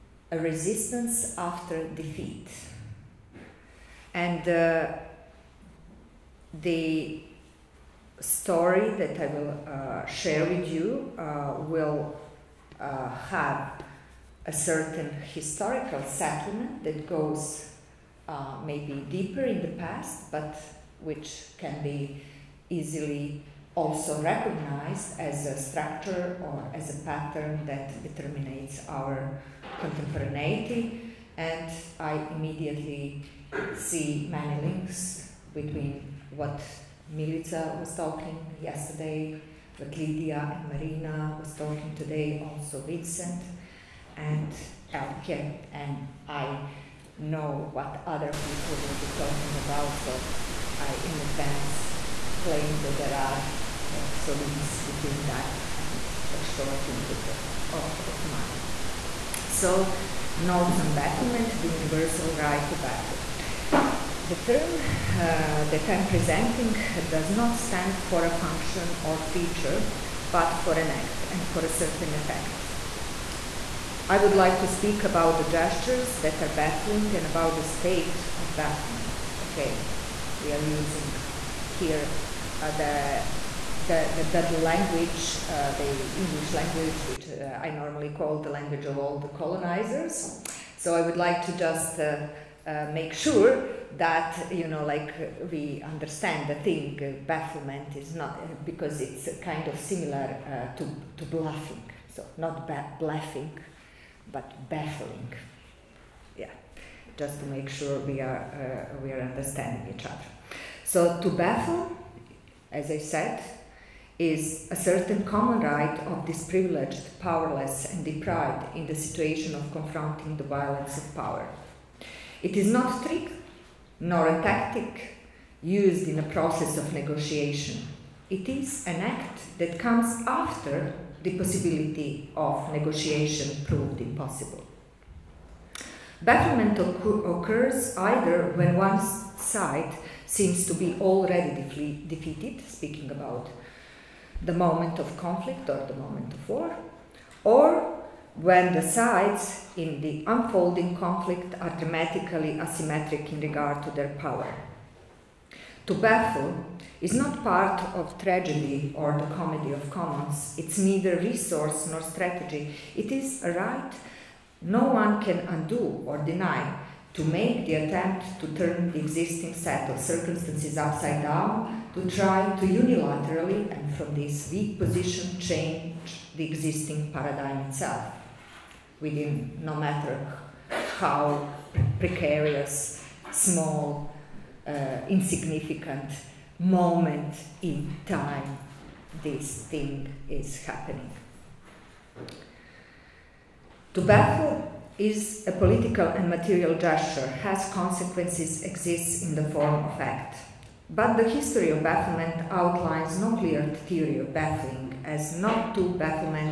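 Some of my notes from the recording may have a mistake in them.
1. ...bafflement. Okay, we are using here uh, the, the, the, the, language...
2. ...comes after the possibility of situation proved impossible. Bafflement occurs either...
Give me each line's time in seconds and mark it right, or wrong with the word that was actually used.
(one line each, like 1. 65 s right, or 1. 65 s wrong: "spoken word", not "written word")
1. 78 s right
2. 129 s wrong: "negotiation", not "situation".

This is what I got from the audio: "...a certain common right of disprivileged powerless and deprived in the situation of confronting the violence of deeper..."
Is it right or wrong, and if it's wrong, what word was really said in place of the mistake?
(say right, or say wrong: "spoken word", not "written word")
wrong: "power", not "deeper".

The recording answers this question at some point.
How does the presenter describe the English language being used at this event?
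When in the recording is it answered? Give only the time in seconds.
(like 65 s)
88 s.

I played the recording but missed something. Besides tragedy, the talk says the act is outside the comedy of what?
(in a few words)
commons.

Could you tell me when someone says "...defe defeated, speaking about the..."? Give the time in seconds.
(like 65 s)
141 s.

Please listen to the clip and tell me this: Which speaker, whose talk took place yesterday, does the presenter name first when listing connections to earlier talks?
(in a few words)
Milica.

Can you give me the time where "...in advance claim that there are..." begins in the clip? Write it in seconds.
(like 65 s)
51 s.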